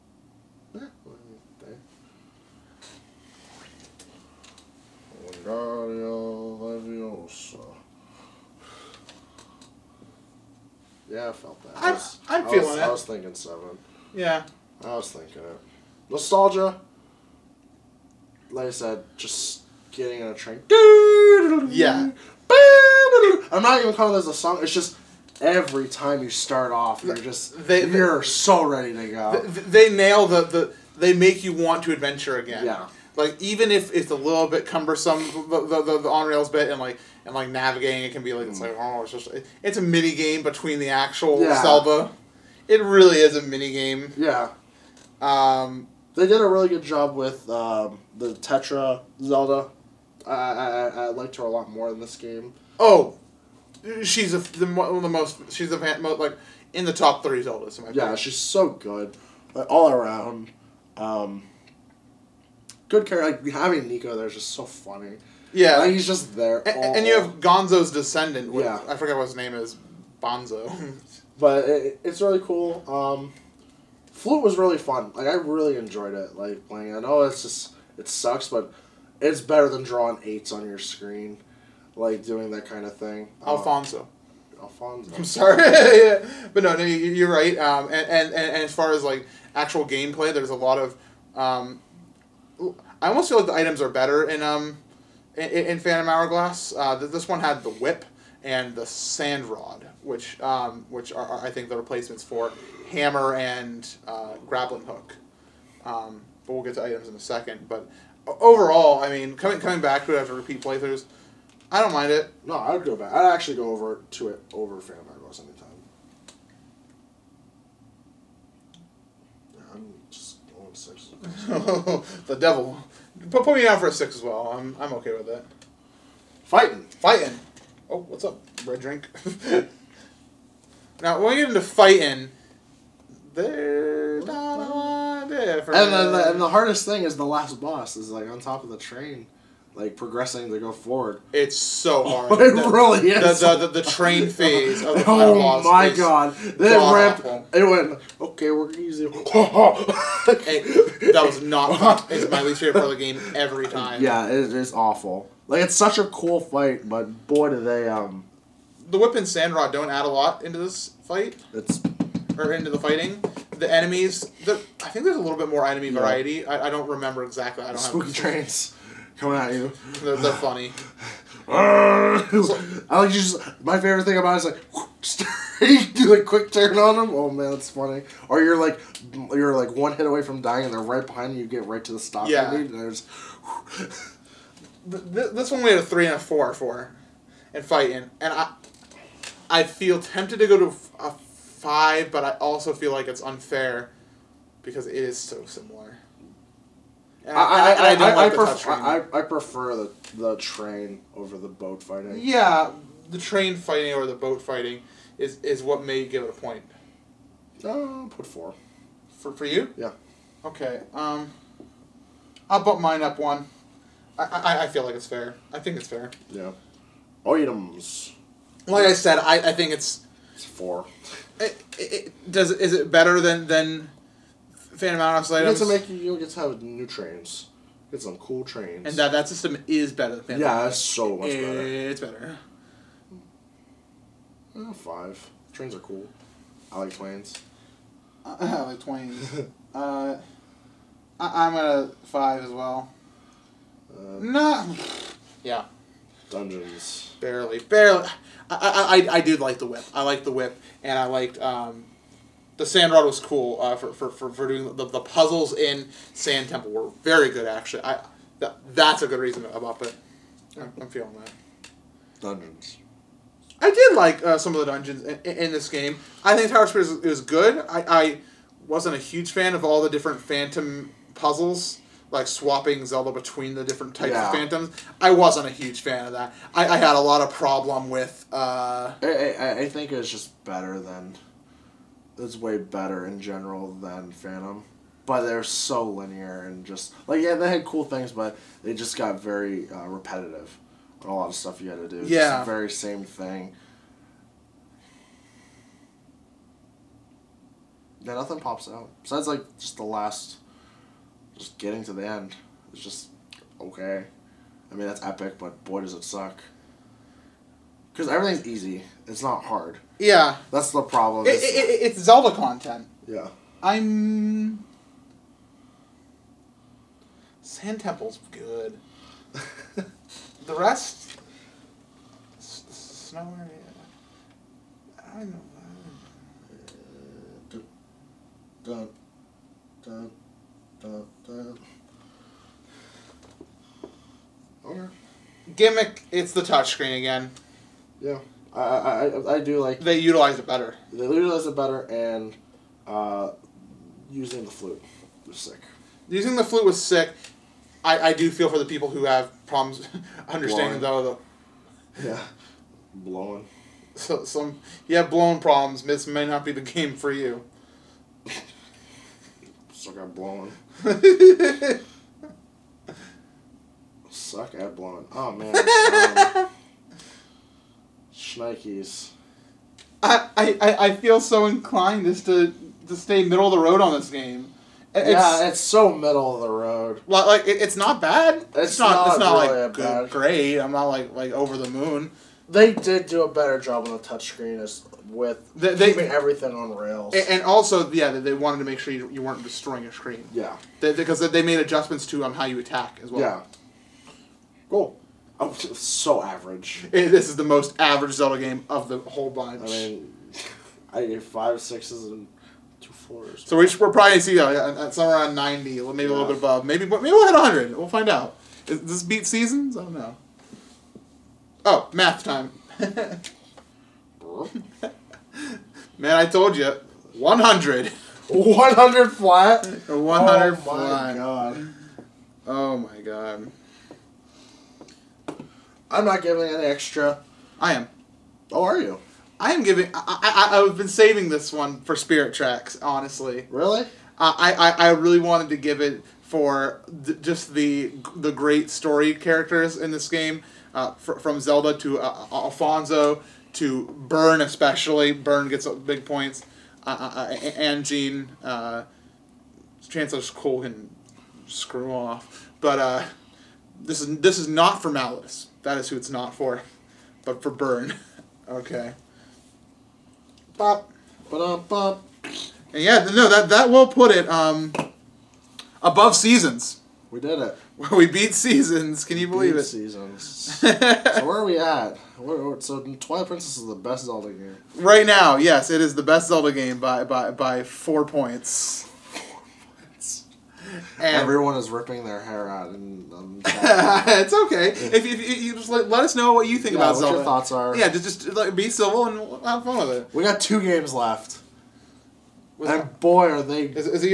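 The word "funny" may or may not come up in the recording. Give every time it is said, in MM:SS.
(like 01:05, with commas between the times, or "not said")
01:04, 02:50, 02:57.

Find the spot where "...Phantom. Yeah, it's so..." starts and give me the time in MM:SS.
03:50.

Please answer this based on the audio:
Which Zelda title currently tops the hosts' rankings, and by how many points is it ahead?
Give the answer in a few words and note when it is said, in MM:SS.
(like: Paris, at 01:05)
Twilight Princess, 4, at 07:52.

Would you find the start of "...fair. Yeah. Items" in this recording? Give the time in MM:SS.
03:35.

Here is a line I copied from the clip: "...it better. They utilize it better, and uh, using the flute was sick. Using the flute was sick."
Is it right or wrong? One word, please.
right.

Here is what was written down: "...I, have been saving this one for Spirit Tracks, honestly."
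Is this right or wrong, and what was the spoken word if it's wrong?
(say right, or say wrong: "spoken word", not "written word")
right.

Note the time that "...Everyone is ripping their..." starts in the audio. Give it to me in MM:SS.
08:01.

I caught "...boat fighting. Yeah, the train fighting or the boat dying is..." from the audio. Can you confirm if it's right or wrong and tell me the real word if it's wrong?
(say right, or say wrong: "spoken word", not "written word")
wrong: "fighting", not "dying".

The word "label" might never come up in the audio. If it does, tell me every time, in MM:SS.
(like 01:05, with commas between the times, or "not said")
not said.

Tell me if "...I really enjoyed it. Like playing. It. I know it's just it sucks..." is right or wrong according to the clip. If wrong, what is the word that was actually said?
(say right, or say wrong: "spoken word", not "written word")
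right.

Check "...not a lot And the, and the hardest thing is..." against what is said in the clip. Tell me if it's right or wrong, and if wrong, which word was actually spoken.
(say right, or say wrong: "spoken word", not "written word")
right.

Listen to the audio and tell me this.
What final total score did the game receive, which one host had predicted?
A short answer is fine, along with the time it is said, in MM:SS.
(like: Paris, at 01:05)
100, at 06:58.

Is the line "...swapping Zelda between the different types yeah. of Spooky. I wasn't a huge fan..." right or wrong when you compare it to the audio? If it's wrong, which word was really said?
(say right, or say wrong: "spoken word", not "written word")
wrong: "Phantoms", not "Spooky".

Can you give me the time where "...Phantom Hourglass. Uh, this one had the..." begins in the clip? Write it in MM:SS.
01:35.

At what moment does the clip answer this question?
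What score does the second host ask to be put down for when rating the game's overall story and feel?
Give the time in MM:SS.
02:03.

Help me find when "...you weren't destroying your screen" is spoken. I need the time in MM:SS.
06:29.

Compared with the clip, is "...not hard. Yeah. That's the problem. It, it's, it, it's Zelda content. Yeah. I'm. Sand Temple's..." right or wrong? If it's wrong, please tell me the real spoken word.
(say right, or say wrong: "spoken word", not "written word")
right.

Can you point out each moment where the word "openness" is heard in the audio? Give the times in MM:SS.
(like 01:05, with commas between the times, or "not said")
not said.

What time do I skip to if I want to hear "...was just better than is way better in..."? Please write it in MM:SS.
04:39.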